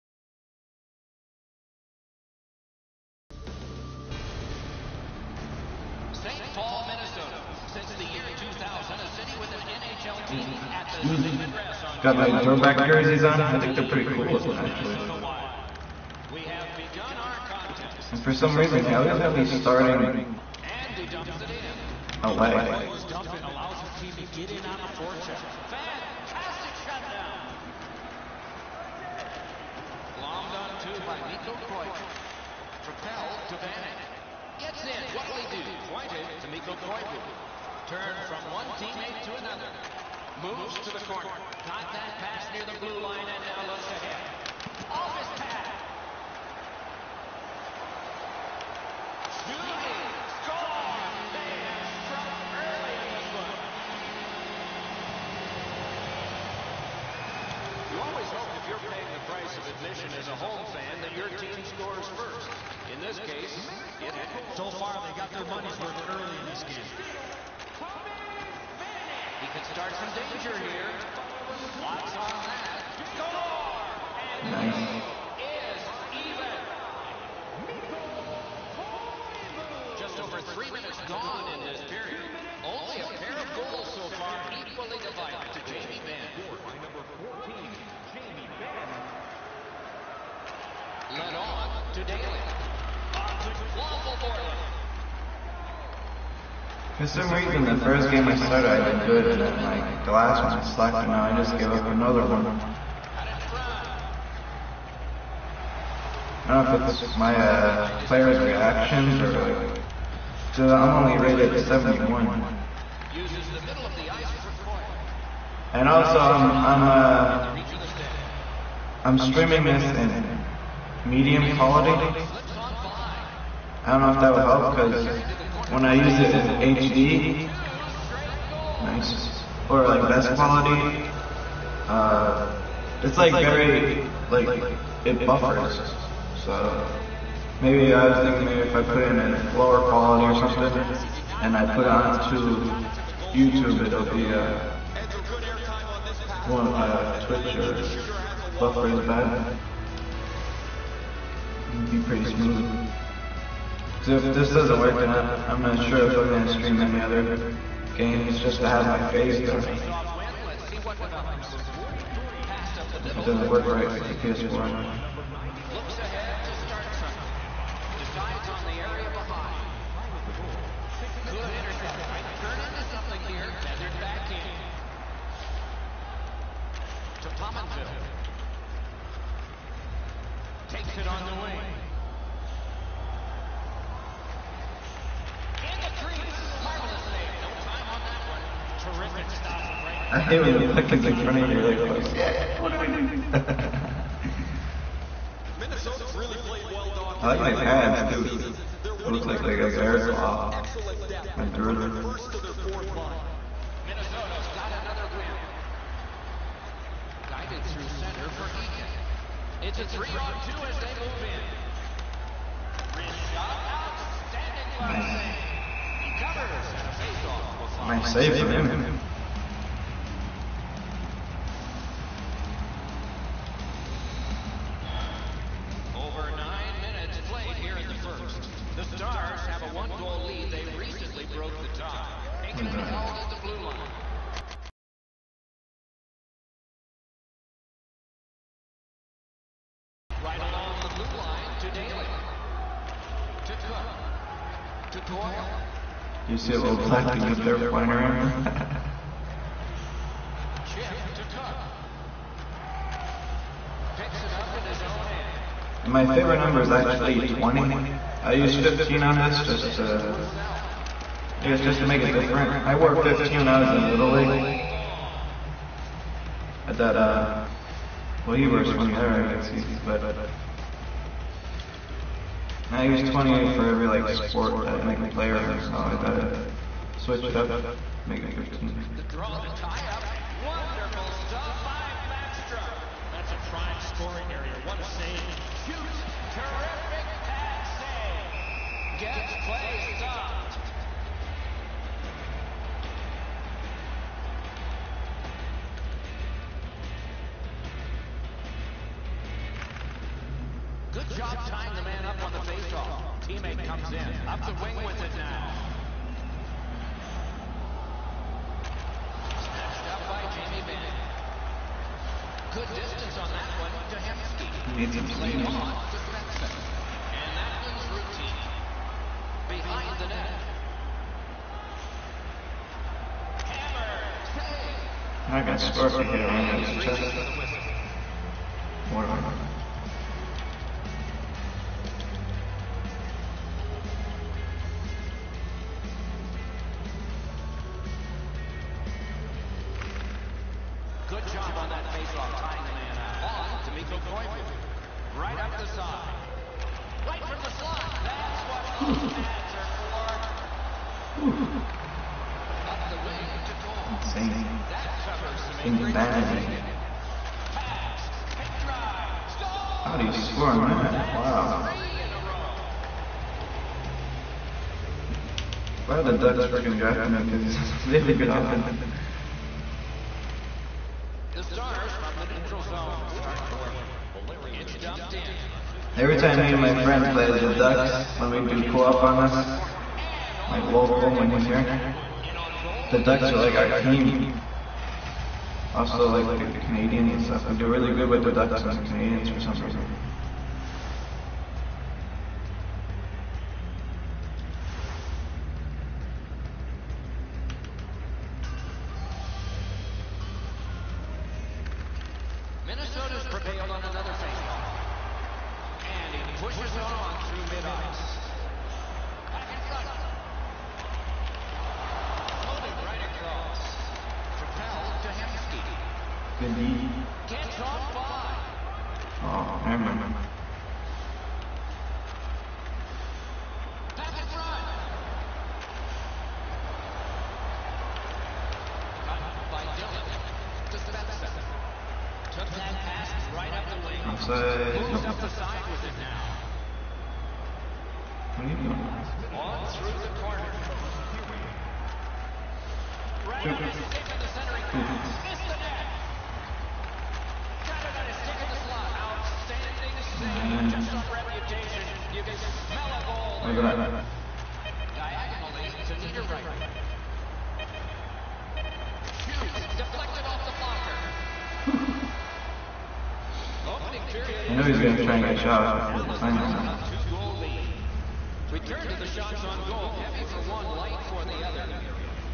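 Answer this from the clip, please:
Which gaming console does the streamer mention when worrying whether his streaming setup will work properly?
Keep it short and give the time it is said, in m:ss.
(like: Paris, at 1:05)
PS4, at 2:44.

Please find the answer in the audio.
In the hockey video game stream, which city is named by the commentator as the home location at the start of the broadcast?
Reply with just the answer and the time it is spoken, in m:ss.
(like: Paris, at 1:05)
St. Paul, Minnesota, at 0:06.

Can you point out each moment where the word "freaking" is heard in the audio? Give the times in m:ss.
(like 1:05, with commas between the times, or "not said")
6:06.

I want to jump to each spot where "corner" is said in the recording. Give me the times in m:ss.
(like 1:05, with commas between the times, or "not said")
0:41, 7:20.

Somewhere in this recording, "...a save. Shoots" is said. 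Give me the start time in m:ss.
4:44.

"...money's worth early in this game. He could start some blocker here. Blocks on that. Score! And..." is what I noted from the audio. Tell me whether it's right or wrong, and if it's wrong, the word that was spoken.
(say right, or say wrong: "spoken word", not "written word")
wrong: "danger", not "blocker".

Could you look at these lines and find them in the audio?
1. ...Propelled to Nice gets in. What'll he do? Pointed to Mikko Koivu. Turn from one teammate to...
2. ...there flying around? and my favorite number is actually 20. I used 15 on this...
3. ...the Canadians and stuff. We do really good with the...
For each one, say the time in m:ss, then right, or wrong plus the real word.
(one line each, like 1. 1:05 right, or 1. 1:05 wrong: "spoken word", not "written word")
1. 0:32 wrong: "Vanek", not "Nice"
2. 4:07 right
3. 6:26 right.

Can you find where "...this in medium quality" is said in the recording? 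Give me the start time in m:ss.
1:59.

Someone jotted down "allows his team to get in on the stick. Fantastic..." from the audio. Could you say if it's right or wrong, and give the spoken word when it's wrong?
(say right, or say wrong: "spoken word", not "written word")
wrong: "forecheck", not "stick".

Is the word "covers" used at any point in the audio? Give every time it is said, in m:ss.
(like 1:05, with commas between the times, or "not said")
3:36, 5:55.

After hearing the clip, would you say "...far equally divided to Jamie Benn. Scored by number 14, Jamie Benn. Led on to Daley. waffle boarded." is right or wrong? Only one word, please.
right.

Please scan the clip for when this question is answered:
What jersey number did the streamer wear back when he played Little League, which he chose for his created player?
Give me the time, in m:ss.
4:22.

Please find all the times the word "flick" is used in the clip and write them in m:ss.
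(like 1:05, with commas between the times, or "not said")
not said.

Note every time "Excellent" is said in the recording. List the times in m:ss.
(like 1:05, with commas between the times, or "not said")
3:20.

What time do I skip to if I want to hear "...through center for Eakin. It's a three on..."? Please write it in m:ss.
3:27.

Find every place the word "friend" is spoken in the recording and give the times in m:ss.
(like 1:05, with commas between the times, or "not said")
6:16.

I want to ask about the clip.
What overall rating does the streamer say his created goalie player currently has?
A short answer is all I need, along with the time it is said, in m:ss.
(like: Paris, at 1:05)
71, at 1:50.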